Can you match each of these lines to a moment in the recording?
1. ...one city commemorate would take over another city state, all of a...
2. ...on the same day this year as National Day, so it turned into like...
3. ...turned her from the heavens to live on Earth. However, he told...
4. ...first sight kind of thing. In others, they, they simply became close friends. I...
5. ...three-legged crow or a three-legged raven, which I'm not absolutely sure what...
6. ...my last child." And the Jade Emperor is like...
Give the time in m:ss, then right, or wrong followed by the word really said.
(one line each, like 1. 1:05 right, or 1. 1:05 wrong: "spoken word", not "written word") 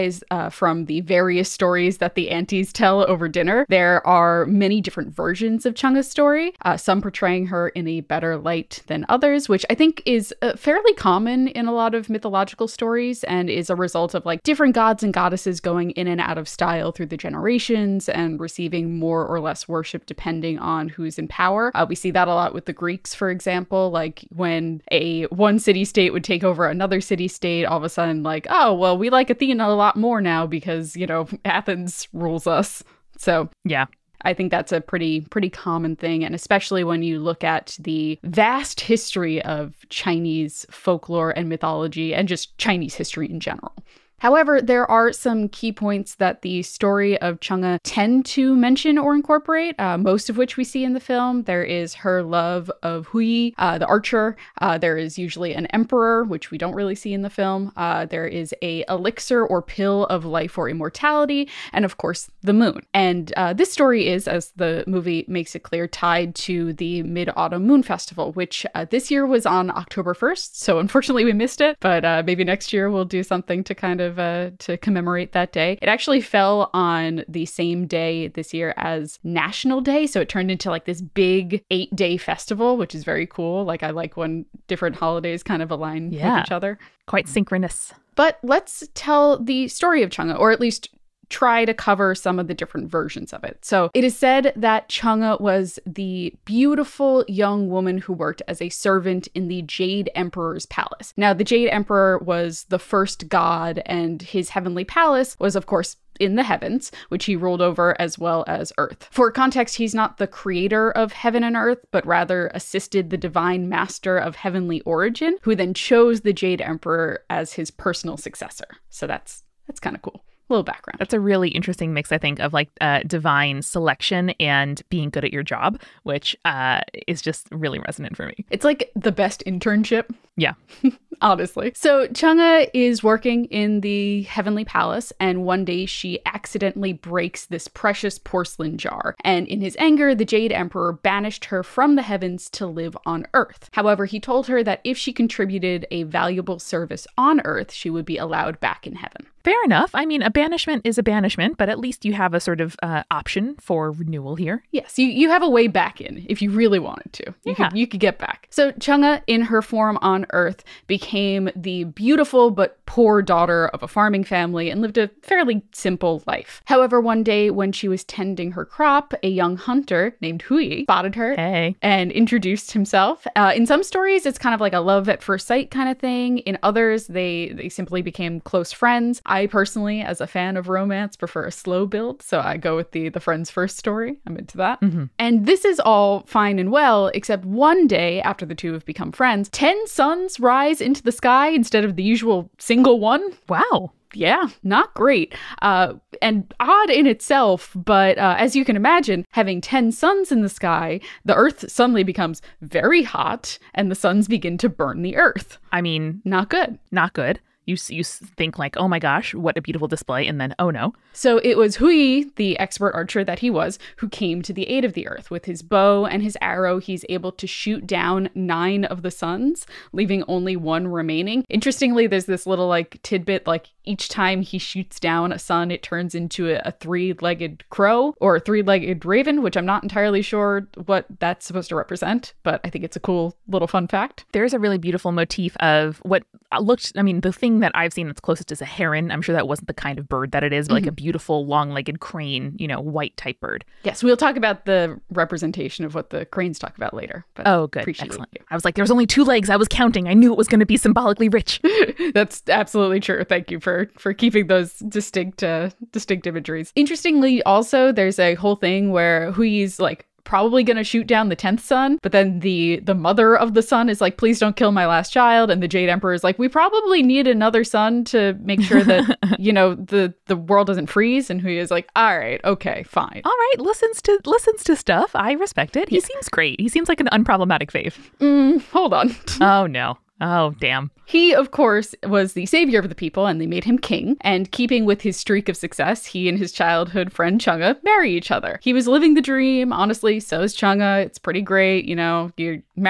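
1. 0:25 wrong: "state", not "commemorate"
2. 1:16 right
3. 2:20 wrong: "banished", not "turned"
4. 2:55 right
5. 3:46 wrong: "entirely", not "absolutely"
6. 4:24 right.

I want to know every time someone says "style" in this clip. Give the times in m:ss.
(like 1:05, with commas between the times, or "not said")
0:16.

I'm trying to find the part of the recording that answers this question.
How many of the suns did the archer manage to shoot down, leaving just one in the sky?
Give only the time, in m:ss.
3:38.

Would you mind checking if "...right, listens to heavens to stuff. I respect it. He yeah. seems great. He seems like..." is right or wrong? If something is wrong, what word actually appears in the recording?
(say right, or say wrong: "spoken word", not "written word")
wrong: "listens", not "heavens".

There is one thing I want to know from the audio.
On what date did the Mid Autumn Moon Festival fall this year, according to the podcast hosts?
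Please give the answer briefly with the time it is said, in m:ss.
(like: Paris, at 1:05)
October 1st, at 1:09.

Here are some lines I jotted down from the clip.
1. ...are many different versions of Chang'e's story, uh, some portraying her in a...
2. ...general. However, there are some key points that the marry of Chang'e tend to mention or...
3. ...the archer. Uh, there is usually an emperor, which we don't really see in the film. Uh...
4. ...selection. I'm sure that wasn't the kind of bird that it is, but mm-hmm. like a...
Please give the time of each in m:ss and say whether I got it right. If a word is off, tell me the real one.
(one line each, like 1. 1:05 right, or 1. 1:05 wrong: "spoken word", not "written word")
1. 0:04 right
2. 0:43 wrong: "story", not "marry"
3. 0:53 right
4. 3:58 wrong: "heron", not "selection".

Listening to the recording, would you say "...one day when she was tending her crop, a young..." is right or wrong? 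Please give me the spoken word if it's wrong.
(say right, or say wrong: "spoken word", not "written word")
right.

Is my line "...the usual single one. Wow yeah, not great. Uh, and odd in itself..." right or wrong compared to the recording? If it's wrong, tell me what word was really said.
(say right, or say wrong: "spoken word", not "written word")
right.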